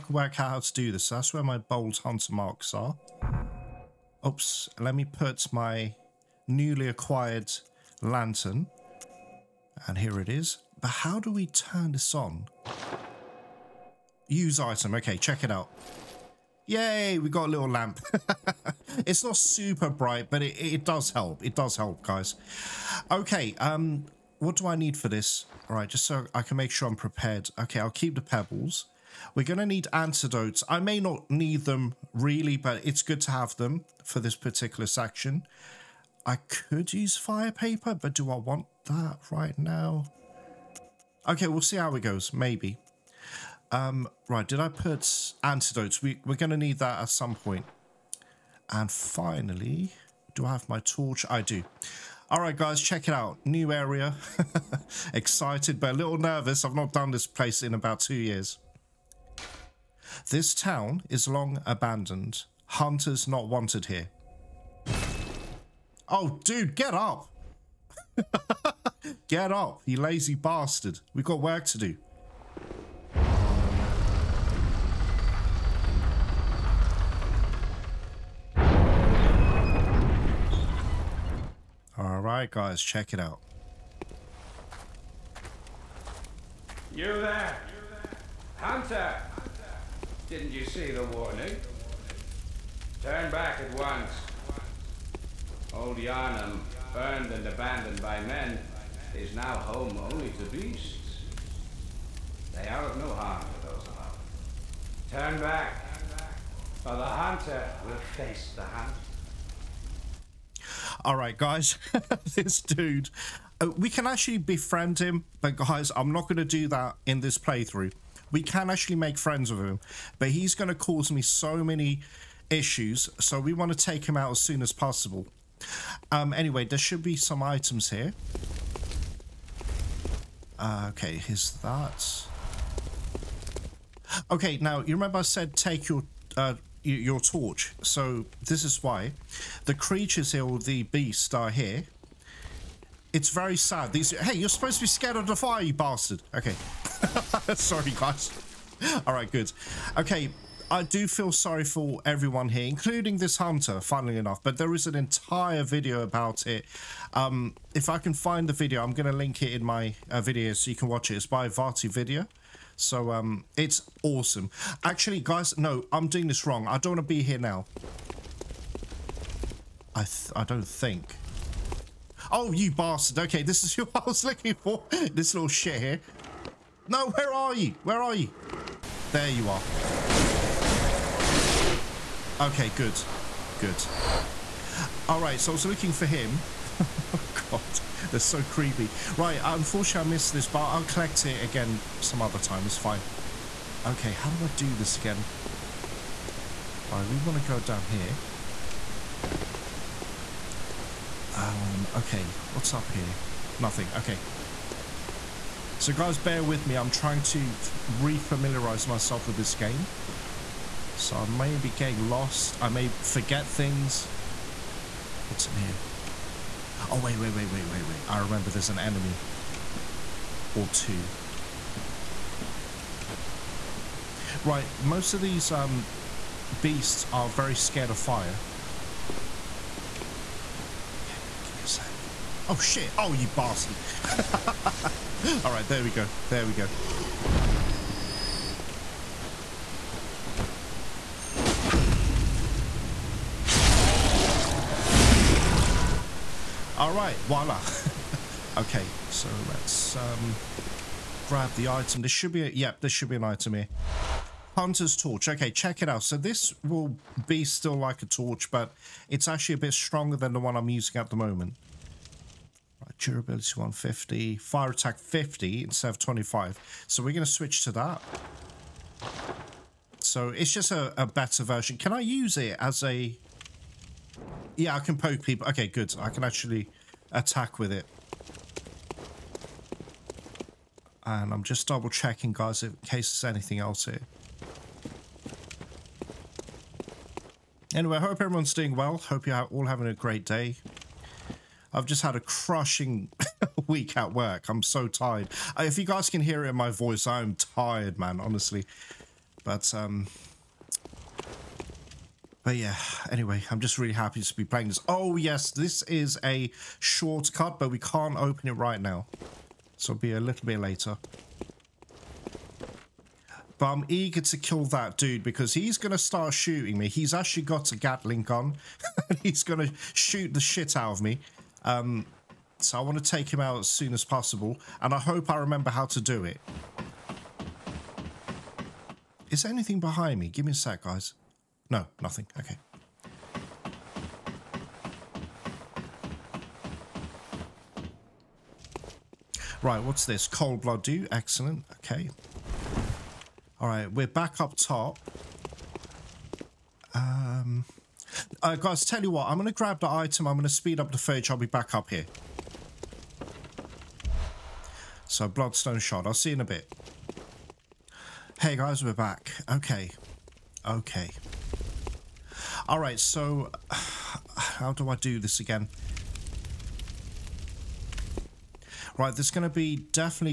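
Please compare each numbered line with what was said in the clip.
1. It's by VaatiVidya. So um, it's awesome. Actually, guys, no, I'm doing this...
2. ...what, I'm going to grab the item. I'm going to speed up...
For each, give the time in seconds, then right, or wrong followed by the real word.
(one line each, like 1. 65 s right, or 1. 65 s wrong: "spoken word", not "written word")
1. 161 s right
2. 349 s right.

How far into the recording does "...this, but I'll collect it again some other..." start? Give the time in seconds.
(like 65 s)
190 s.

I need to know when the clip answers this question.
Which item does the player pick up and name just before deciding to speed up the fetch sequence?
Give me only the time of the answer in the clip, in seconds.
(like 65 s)
340 s.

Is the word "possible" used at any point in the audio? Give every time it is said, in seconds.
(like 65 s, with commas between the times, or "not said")
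124 s, 324 s.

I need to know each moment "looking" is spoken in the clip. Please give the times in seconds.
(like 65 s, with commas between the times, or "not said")
174 s, 185 s.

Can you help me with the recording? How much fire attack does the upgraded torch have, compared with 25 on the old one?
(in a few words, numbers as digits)
50.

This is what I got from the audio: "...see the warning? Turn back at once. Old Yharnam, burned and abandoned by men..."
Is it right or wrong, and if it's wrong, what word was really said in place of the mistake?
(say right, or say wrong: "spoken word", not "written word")
right.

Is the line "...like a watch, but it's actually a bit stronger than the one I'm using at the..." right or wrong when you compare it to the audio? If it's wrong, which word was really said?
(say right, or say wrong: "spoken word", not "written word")
wrong: "torch", not "watch".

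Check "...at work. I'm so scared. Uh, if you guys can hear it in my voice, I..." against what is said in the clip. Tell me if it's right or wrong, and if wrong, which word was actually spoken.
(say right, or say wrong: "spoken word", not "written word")
wrong: "tired", not "scared".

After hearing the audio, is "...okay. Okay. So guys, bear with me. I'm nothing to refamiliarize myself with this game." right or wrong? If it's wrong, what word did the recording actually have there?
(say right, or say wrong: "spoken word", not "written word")
wrong: "trying", not "nothing".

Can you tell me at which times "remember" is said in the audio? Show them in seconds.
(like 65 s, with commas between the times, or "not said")
134 s, 218 s, 325 s.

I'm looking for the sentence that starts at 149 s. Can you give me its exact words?
Okay, I do feel sorry for everyone here, including this hunter, funnily enough, but there is an entire video about it.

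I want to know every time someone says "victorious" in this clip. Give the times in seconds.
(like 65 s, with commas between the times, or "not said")
not said.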